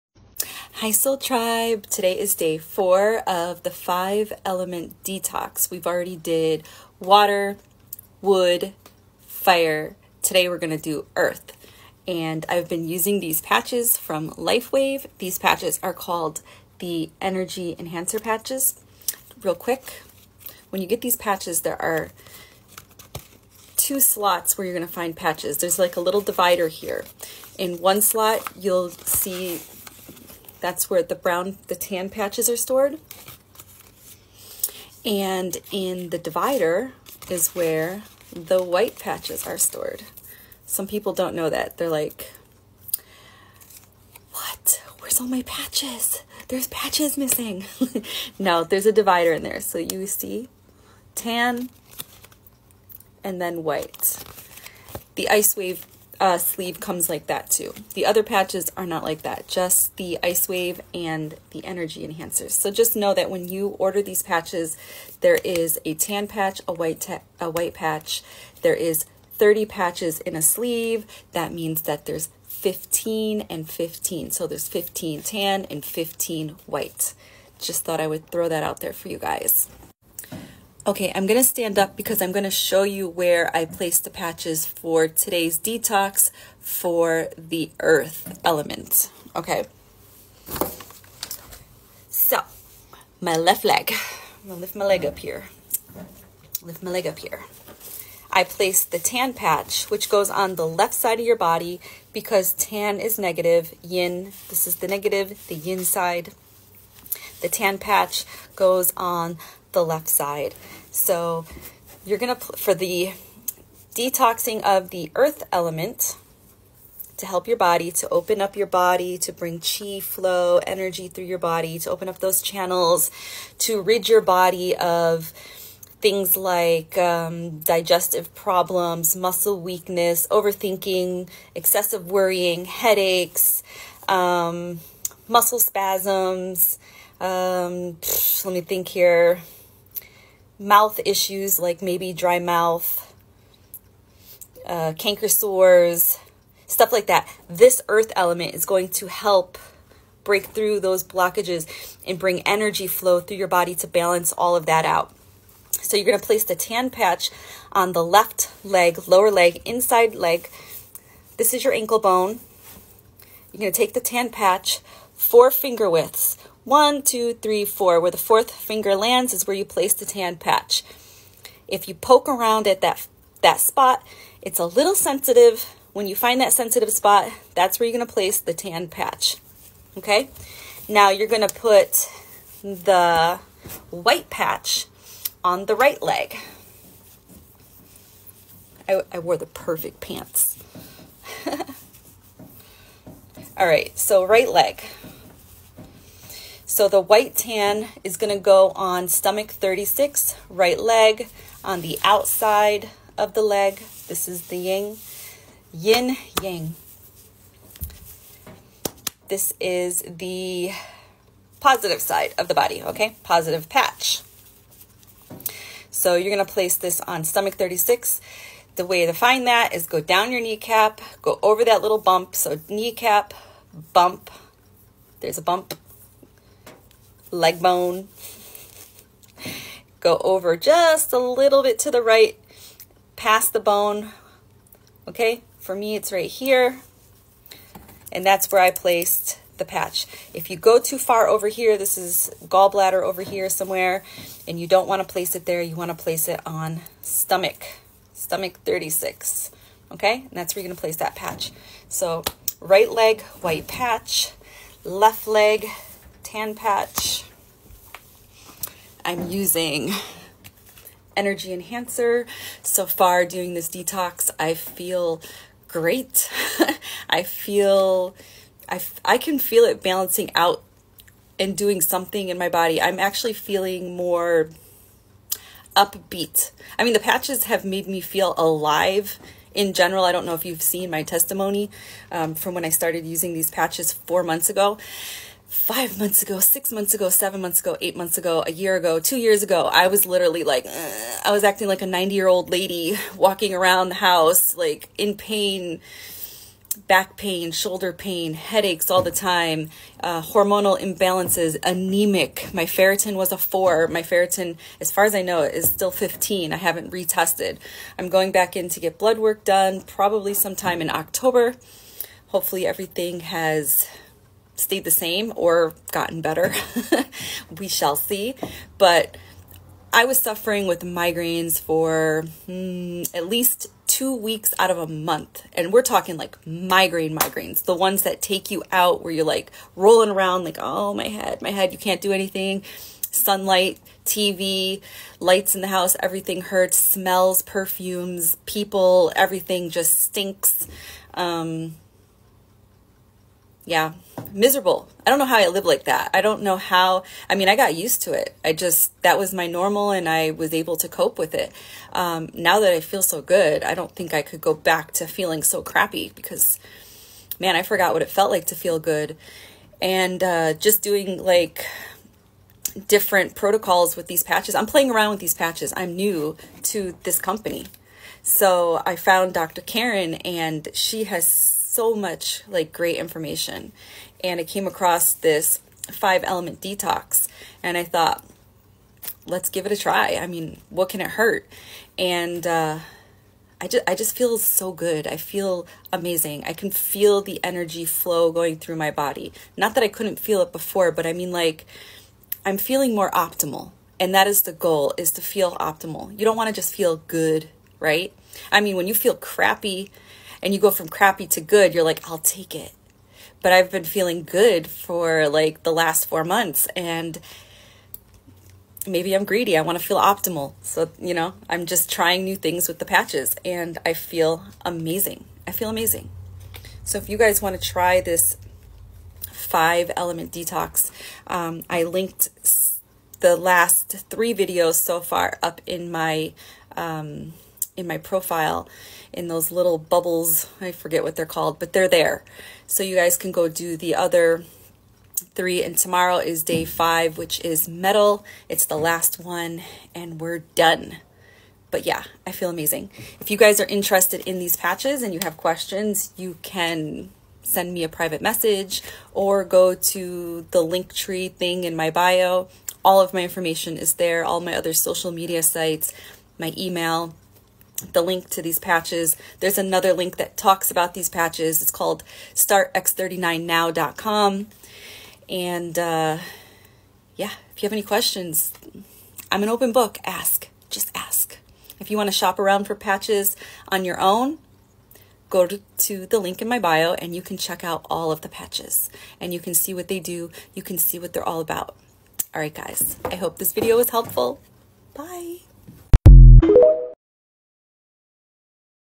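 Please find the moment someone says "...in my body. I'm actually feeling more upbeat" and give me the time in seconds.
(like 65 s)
272 s.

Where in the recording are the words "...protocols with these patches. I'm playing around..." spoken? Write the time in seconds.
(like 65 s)
363 s.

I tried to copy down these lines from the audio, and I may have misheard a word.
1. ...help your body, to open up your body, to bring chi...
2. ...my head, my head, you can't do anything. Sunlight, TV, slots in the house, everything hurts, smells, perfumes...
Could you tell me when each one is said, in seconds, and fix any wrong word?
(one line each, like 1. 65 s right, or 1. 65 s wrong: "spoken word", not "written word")
1. 117 s right
2. 330 s wrong: "lights", not "slots".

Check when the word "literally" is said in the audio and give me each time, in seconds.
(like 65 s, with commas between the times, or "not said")
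290 s.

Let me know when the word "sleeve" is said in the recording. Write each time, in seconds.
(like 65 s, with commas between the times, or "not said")
56 s, 70 s.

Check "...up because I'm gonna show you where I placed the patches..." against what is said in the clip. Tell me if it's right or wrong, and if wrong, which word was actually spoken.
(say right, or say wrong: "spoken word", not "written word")
right.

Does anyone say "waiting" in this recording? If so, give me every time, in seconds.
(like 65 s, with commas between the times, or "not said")
not said.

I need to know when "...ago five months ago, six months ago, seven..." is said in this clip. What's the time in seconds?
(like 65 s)
284 s.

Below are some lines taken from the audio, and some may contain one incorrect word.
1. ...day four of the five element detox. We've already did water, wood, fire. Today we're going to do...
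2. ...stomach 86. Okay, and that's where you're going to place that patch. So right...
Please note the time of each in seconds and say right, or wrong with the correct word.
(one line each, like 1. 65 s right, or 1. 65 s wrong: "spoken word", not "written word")
1. 2 s right
2. 248 s wrong: "36", not "86".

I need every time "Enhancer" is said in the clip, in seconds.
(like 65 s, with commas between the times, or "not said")
17 s, 62 s, 261 s.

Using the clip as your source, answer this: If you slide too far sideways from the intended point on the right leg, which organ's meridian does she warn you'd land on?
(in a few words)
Gallbladder.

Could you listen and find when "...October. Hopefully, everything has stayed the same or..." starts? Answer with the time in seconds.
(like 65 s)
310 s.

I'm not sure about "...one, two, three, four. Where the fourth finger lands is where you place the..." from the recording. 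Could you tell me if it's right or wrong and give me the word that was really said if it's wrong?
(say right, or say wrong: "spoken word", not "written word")
right.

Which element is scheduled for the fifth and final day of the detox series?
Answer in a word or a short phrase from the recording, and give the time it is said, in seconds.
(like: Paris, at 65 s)
Metal, at 437 s.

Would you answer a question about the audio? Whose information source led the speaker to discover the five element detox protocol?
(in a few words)
Dr. Karen.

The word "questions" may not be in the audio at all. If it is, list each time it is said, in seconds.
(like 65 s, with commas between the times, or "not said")
445 s, 467 s.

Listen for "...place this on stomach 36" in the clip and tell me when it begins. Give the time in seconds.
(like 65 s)
216 s.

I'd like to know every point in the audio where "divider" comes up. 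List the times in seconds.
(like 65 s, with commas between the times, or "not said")
26 s, 36 s, 48 s.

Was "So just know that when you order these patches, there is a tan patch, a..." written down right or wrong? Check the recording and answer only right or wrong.
right.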